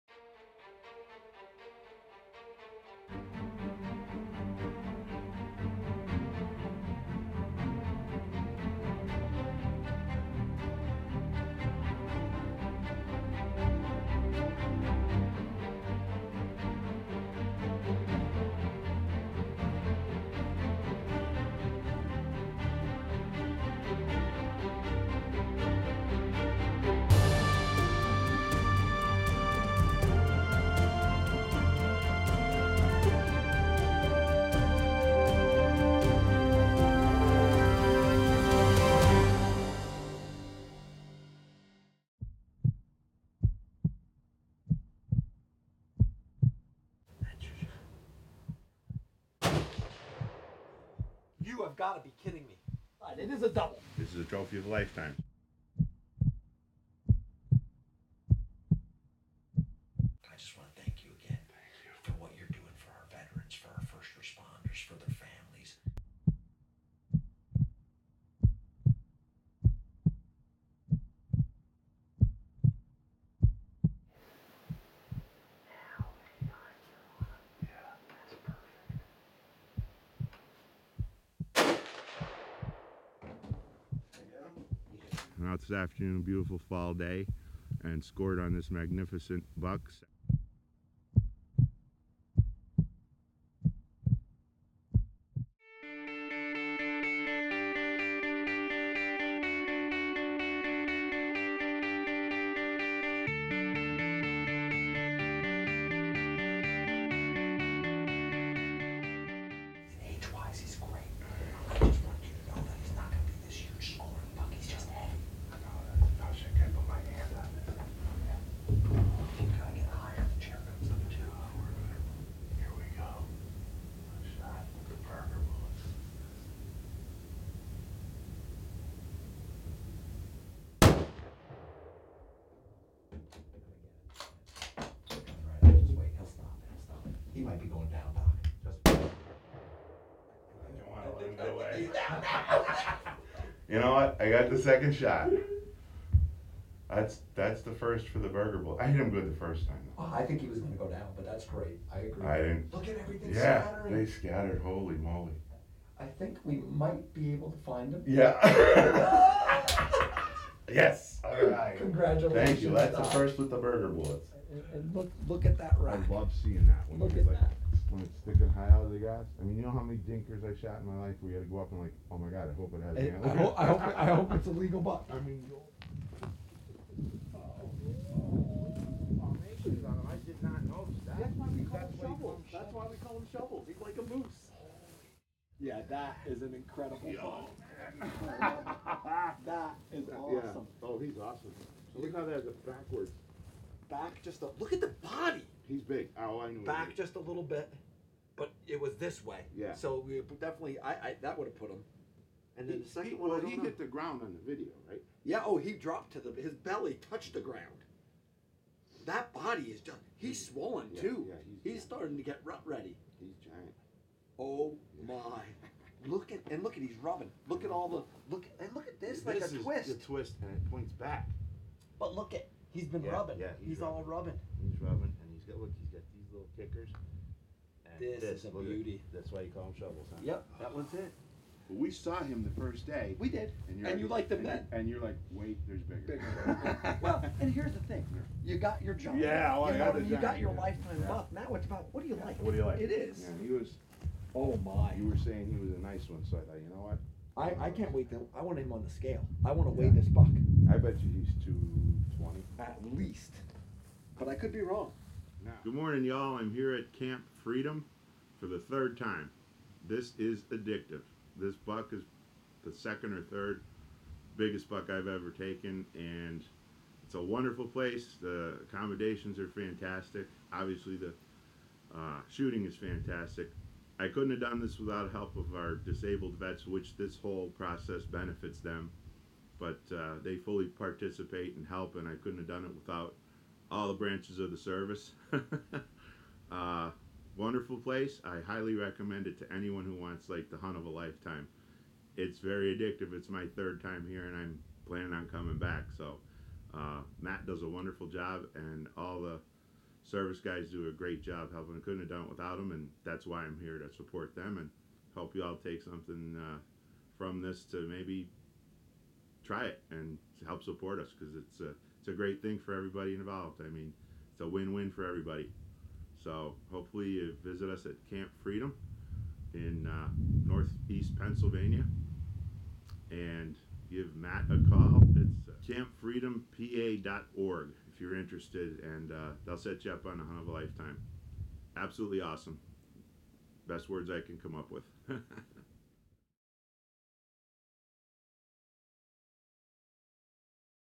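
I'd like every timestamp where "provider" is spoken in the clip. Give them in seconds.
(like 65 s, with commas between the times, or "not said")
not said.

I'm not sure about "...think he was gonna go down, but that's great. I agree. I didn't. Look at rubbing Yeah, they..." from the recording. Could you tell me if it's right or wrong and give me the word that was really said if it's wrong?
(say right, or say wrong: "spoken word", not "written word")
wrong: "everything", not "rubbing".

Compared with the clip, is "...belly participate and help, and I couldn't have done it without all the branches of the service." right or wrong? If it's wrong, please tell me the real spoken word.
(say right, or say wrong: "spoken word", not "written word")
wrong: "fully", not "belly".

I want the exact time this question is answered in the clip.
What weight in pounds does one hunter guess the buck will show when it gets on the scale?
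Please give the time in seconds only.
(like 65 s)
251 s.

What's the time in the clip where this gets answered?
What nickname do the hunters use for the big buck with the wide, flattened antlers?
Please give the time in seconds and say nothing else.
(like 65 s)
183 s.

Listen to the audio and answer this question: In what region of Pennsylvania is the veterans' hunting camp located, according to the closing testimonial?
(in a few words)
Northeast Pennsylvania.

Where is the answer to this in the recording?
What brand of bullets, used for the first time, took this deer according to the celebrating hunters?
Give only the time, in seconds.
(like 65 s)
163 s.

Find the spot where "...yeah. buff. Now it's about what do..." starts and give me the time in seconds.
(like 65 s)
241 s.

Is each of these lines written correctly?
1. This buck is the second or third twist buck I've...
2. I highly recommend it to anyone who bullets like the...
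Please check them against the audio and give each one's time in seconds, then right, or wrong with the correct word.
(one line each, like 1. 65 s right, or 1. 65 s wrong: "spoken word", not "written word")
1. 261 s wrong: "biggest", not "twist"
2. 288 s wrong: "wants", not "bullets".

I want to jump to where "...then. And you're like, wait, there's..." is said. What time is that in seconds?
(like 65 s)
234 s.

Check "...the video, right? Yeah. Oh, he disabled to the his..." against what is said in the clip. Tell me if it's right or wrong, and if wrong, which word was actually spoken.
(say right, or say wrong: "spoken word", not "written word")
wrong: "dropped", not "disabled".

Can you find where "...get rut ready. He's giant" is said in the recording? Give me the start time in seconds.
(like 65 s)
212 s.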